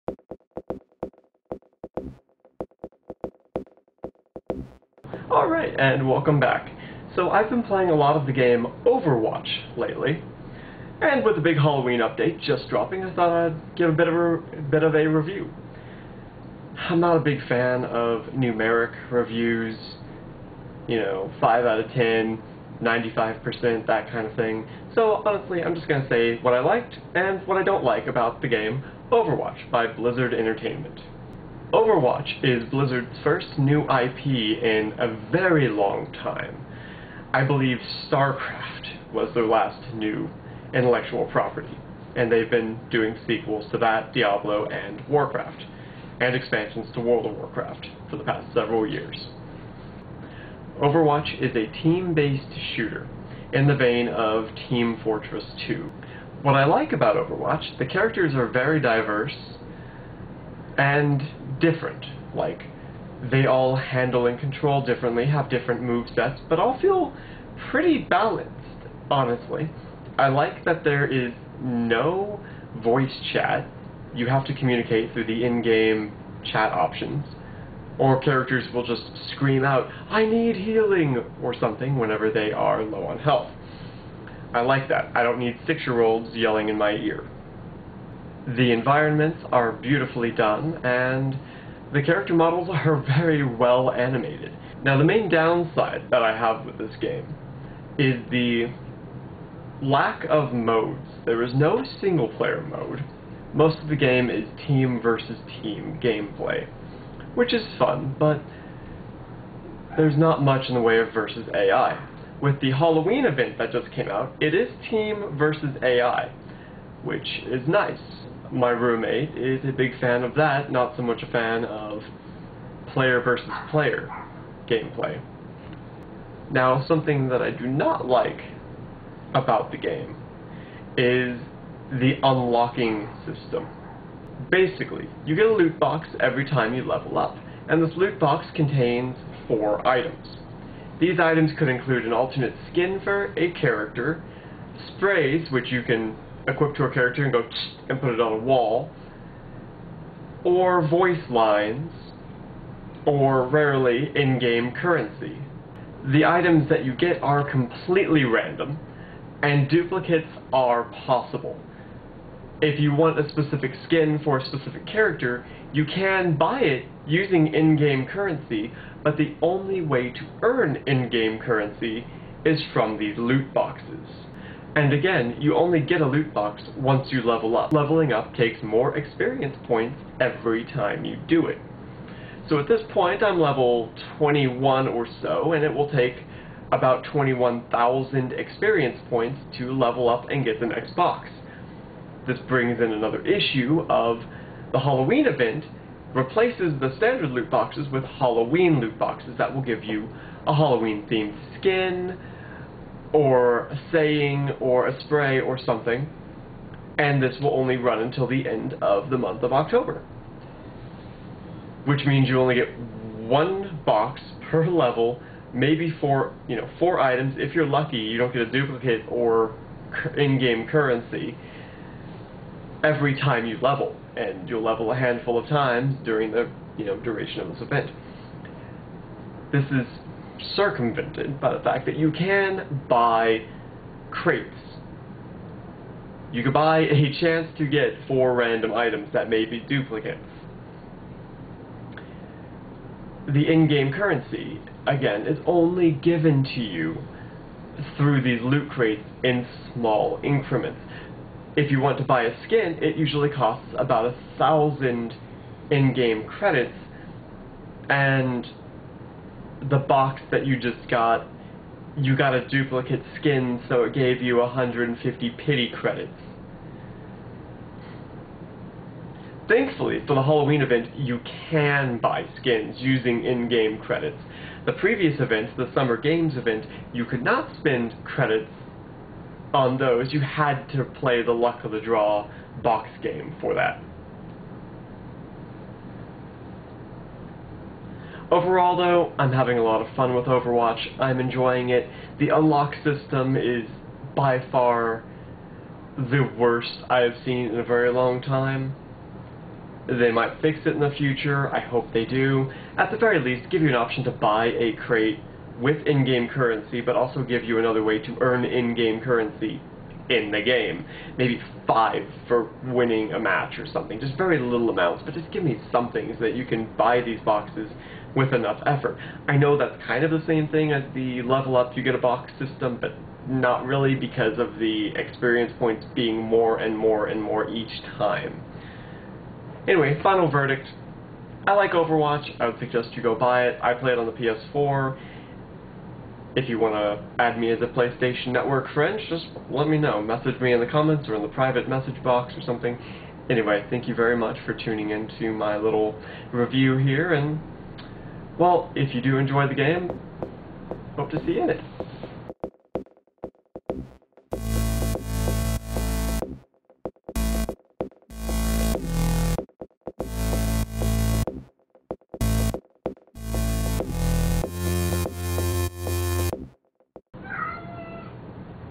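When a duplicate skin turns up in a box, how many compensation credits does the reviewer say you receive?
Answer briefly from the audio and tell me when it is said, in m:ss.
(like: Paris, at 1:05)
150, at 4:24.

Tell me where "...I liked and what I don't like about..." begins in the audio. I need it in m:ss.
0:26.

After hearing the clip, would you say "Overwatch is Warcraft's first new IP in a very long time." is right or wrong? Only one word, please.
wrong.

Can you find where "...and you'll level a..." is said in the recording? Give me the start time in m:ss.
3:44.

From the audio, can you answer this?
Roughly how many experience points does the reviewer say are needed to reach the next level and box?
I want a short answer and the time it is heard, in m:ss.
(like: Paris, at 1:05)
21,000, at 3:07.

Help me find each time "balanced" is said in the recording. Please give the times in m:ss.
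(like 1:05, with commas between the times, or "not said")
1:07.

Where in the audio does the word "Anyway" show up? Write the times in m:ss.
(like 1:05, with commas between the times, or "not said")
5:29, 5:43.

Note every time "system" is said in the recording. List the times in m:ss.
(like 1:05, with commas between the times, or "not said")
2:13, 4:52, 5:22.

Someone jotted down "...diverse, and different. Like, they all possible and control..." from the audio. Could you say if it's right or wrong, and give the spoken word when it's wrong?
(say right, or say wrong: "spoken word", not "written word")
wrong: "handle", not "possible".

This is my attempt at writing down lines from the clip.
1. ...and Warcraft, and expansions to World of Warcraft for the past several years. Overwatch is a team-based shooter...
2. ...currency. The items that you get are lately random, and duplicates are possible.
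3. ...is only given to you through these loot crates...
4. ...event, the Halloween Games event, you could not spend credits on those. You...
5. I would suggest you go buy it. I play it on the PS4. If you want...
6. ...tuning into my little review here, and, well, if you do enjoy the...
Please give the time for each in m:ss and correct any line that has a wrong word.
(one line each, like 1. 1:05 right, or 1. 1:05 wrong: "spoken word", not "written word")
1. 0:44 right
2. 2:34 wrong: "completely", not "lately"
3. 4:05 right
4. 4:35 wrong: "Summer", not "Halloween"
5. 5:32 right
6. 5:44 right.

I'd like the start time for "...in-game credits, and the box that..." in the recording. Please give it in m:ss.
4:15.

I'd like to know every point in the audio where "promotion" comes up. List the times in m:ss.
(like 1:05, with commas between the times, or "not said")
not said.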